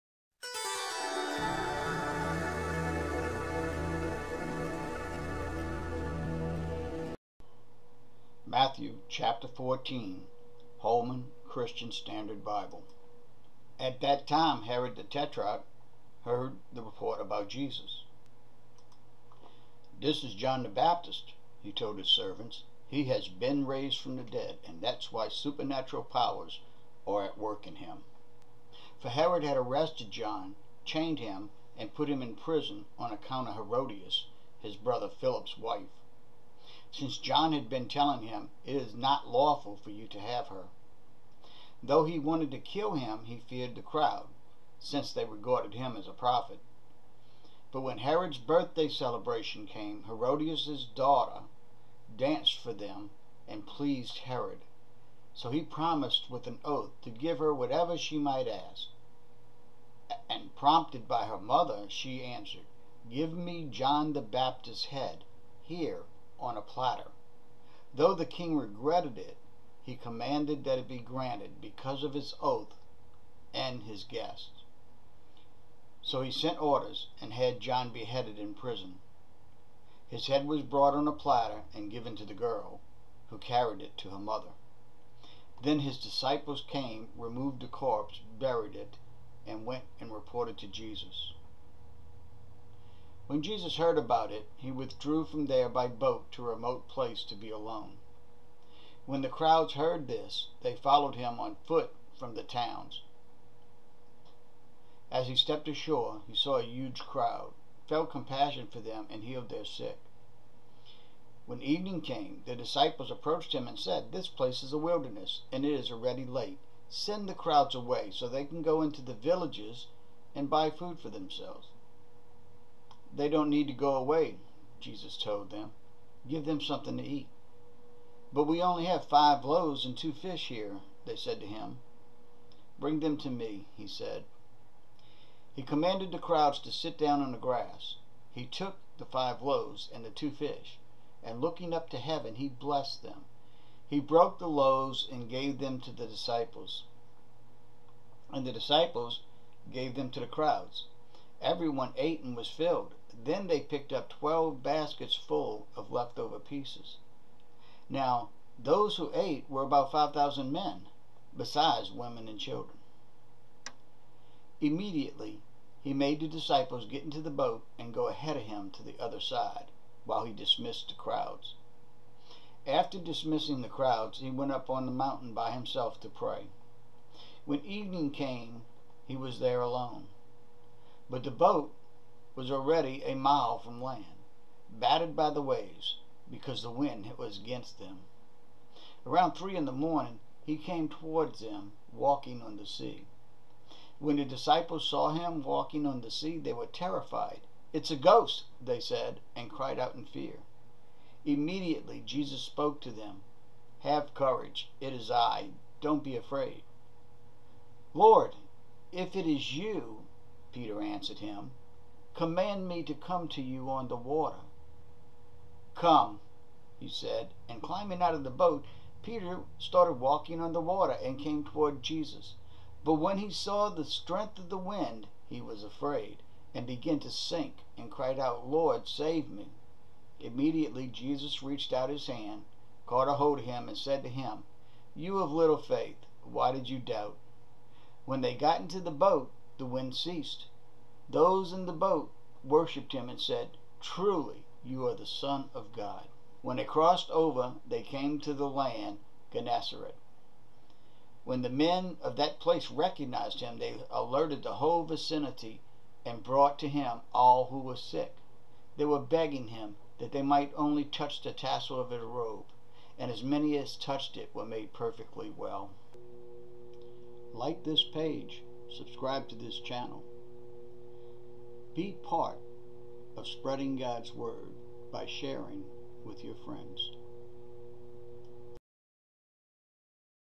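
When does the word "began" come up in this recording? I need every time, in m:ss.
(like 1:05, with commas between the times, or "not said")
3:46.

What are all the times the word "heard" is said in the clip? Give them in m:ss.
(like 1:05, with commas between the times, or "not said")
0:16, 1:33, 1:39.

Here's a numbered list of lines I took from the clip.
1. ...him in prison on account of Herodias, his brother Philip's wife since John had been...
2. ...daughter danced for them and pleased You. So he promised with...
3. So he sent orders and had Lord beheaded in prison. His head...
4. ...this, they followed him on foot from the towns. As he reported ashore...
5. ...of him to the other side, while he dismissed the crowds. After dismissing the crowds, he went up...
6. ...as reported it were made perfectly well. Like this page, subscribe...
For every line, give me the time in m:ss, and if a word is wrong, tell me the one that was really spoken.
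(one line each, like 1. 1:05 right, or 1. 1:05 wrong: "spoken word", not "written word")
1. 0:32 right
2. 0:50 wrong: "Herod", not "You"
3. 1:16 wrong: "John", not "Lord"
4. 1:40 wrong: "stepped", not "reported"
5. 2:48 right
6. 4:23 wrong: "touched", not "reported".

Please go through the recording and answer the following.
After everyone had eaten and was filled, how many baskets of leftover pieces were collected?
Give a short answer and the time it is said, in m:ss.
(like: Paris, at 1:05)
12, at 2:34.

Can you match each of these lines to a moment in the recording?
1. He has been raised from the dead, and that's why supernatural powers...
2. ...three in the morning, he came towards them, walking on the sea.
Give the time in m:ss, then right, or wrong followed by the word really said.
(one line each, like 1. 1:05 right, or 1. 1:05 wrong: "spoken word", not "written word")
1. 0:22 right
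2. 3:09 right.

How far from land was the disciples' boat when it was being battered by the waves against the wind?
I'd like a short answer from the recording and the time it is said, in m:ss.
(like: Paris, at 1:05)
a mile, at 3:03.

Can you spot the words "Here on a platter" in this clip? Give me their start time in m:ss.
1:05.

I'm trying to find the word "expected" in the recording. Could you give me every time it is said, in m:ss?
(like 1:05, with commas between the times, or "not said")
not said.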